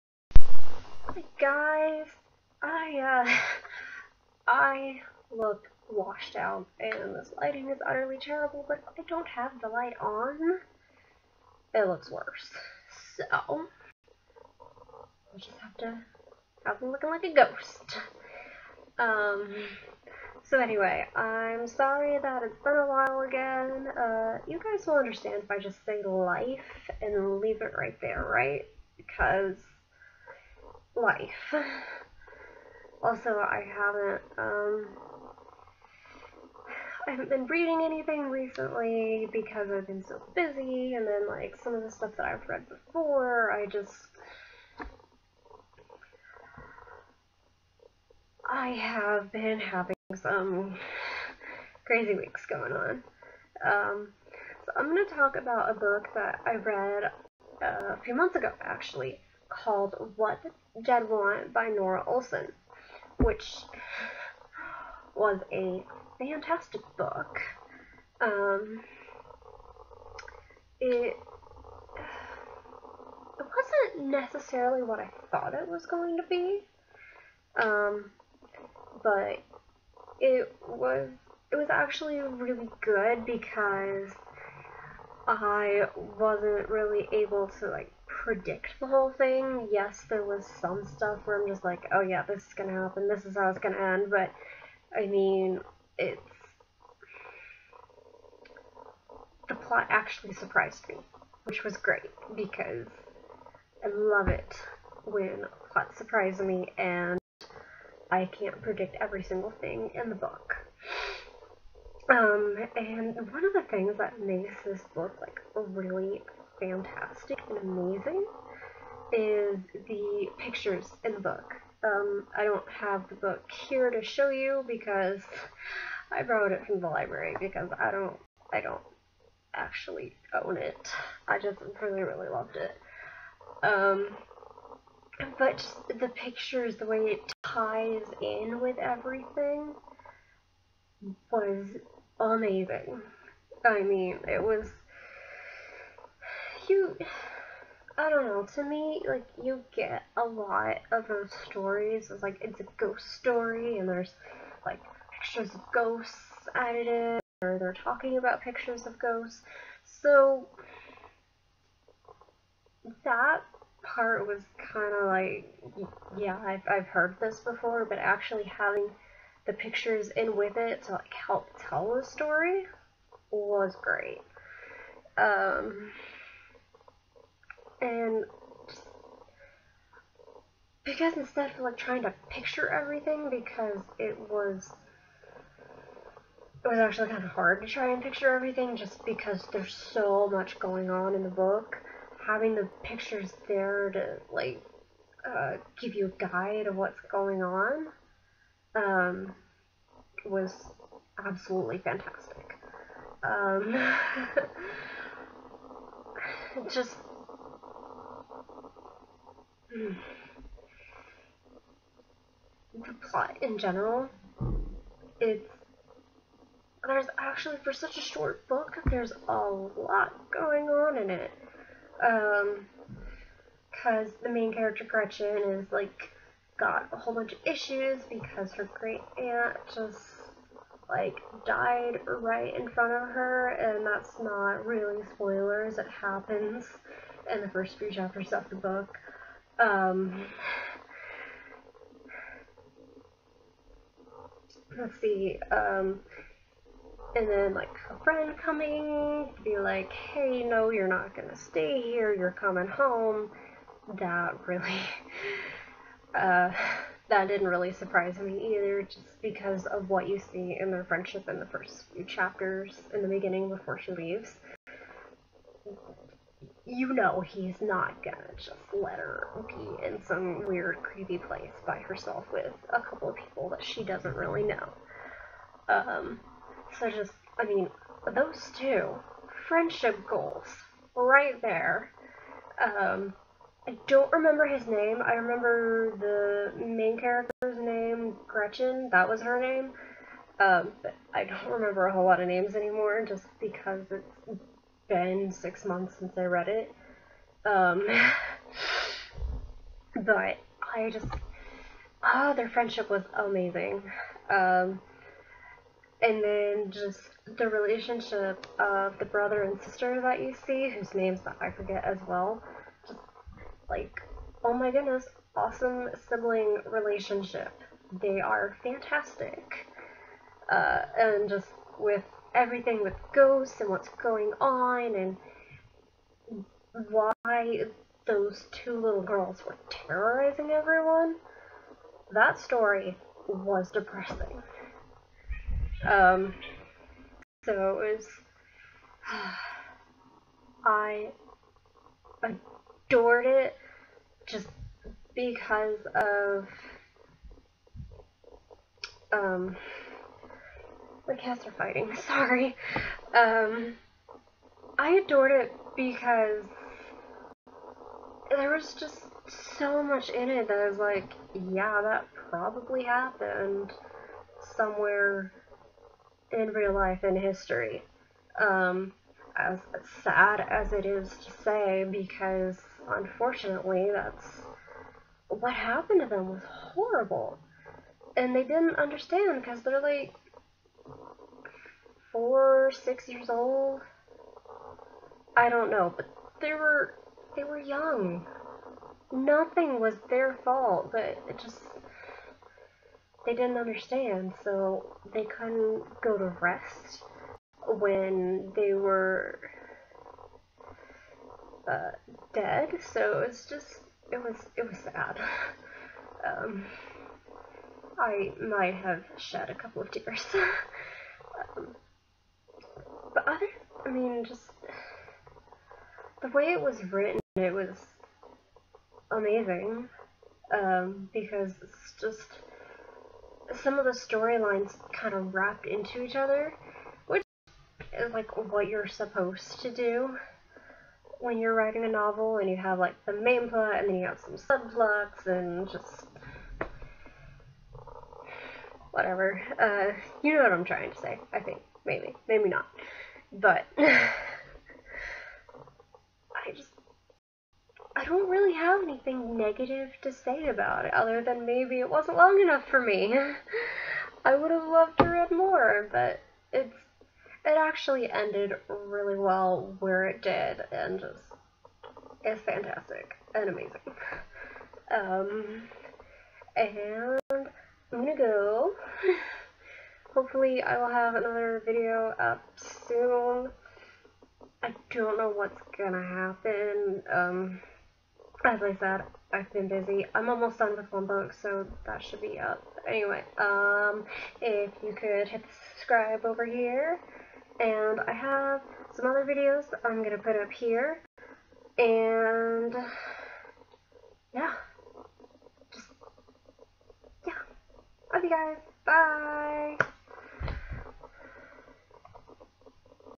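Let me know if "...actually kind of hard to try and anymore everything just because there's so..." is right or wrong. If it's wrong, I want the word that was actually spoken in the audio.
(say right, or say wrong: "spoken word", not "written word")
wrong: "picture", not "anymore".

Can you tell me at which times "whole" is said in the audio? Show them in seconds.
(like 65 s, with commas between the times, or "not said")
88 s, 226 s, 291 s.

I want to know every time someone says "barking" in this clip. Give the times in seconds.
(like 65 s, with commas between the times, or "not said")
not said.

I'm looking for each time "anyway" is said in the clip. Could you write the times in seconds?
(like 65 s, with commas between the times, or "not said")
20 s, 482 s.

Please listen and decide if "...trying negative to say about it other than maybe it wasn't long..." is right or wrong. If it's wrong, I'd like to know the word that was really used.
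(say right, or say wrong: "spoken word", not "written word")
wrong: "anything", not "trying".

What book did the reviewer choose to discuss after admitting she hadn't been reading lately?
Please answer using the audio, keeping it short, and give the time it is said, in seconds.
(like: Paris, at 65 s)
What Dead Want, at 60 s.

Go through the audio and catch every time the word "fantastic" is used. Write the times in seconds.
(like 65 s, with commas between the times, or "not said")
66 s, 116 s, 201 s, 318 s, 462 s.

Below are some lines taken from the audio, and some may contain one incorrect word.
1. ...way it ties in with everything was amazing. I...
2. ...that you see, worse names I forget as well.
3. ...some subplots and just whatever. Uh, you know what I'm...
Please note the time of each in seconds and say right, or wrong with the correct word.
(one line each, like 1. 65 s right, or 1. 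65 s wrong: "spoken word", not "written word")
1. 136 s right
2. 310 s wrong: "whose", not "worse"
3. 434 s right.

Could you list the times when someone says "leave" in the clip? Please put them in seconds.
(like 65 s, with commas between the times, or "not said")
27 s, 263 s.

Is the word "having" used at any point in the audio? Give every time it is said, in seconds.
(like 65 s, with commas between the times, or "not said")
49 s, 168 s, 192 s.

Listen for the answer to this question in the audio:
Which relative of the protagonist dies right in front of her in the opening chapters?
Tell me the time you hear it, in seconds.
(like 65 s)
228 s.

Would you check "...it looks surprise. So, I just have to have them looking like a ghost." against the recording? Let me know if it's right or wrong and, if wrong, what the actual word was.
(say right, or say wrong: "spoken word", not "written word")
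wrong: "worse", not "surprise".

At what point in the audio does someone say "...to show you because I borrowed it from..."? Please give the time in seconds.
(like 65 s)
123 s.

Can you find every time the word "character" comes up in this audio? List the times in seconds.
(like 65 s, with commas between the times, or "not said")
224 s, 286 s.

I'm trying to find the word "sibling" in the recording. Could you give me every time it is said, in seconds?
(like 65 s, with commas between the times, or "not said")
316 s.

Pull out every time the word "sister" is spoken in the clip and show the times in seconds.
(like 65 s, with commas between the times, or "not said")
309 s.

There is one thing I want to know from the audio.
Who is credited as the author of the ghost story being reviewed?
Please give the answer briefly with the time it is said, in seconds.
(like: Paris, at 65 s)
Norah Olson, at 61 s.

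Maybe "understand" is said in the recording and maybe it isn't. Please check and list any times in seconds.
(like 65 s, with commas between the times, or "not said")
24 s, 378 s, 393 s.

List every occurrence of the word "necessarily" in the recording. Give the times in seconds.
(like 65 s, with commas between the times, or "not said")
74 s.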